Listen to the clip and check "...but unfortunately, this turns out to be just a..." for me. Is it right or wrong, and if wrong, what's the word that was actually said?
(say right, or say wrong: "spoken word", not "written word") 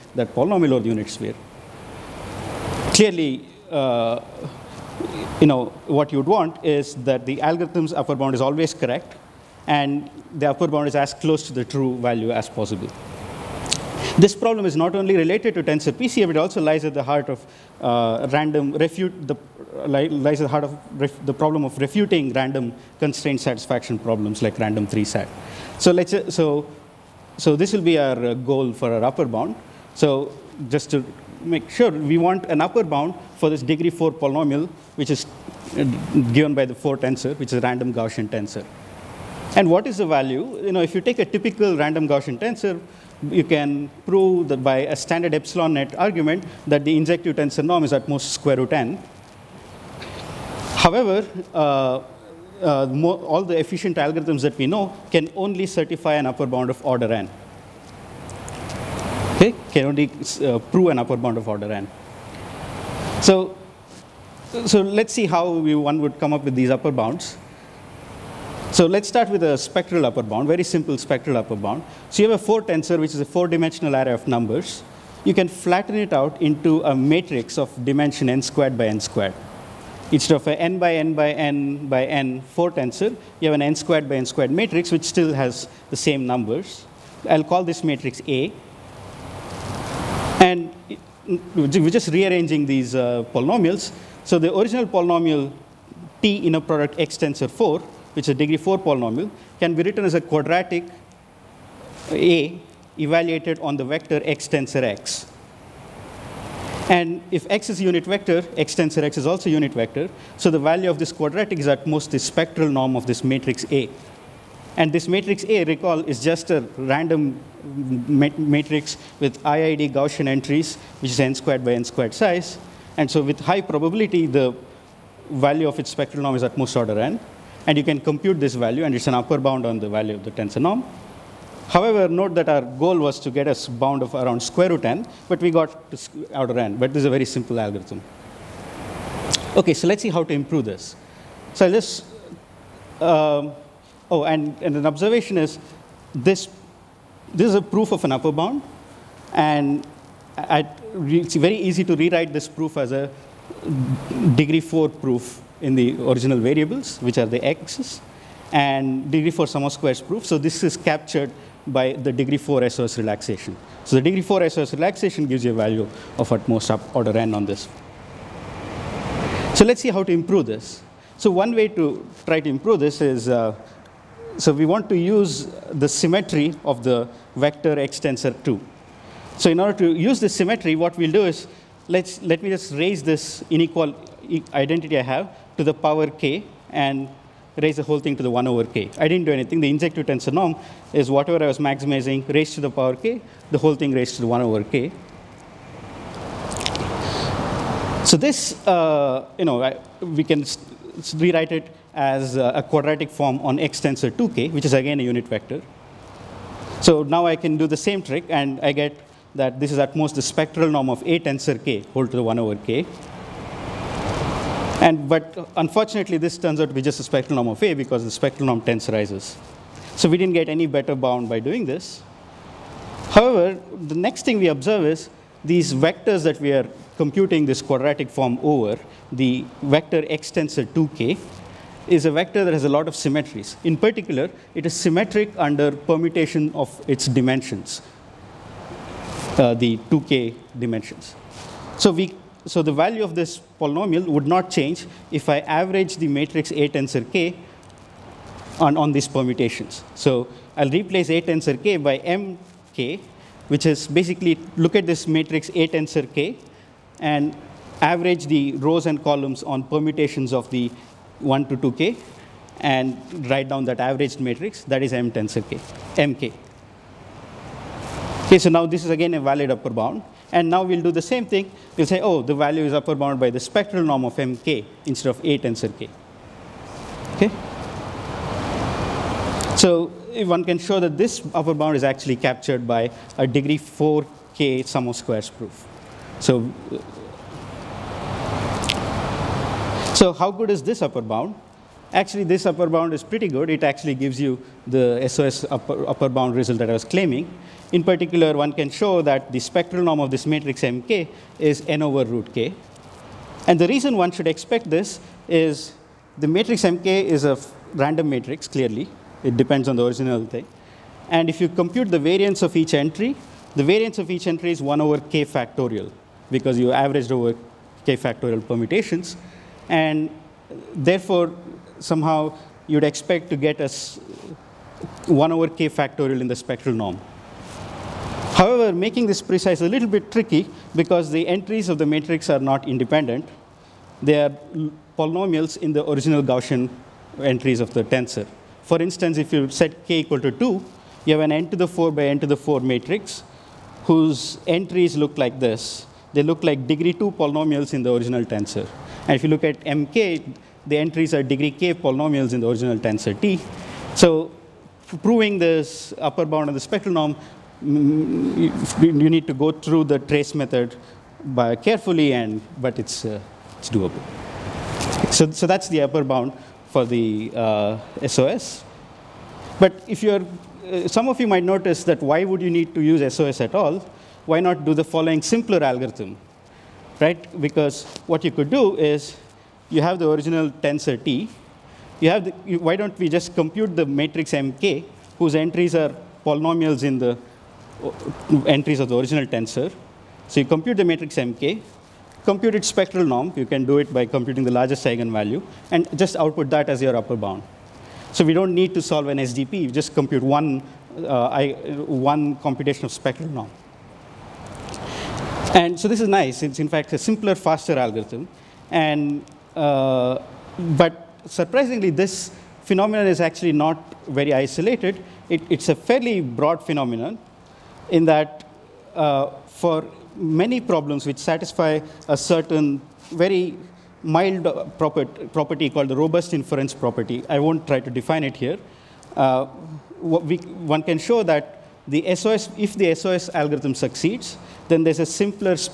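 right.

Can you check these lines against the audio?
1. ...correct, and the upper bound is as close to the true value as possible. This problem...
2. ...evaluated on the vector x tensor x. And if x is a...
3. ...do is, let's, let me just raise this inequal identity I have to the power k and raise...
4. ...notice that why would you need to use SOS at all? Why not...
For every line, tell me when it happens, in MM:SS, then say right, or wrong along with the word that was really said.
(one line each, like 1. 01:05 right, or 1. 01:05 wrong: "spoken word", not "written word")
1. 00:08 right
2. 01:42 right
3. 03:01 right
4. 06:11 right.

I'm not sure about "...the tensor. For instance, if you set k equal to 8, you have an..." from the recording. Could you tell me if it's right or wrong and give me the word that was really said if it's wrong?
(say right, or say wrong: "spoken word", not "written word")
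wrong: "2", not "8".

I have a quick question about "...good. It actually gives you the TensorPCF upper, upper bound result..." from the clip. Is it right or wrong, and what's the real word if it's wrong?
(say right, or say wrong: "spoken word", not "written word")
wrong: "SOS", not "TensorPCF".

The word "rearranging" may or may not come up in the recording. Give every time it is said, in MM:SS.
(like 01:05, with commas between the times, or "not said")
01:32.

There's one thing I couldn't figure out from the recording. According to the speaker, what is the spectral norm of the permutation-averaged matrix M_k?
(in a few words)
n over root k.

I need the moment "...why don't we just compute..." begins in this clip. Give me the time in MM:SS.
06:22.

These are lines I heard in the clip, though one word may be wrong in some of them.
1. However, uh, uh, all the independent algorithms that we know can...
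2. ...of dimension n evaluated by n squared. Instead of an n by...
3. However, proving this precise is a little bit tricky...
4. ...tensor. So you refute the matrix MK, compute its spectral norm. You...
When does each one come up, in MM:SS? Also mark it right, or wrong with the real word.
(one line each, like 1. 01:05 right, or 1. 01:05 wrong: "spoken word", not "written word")
1. 00:50 wrong: "efficient", not "independent"
2. 01:17 wrong: "squared", not "evaluated"
3. 05:28 wrong: "making", not "proving"
4. 06:29 wrong: "compute", not "refute".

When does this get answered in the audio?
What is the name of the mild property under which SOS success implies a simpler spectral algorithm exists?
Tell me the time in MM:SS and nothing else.
07:05.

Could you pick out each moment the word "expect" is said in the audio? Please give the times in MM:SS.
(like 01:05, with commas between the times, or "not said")
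05:04, 05:22.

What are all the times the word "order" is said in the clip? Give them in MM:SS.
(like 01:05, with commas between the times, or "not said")
00:56, 01:01, 02:06, 02:46, 02:59.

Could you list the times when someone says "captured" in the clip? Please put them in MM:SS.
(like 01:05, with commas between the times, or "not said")
02:40, 04:42.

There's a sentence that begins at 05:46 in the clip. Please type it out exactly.
They look like degree 2 polynomials in the original tensor.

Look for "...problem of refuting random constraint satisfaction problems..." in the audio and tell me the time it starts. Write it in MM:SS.
00:21.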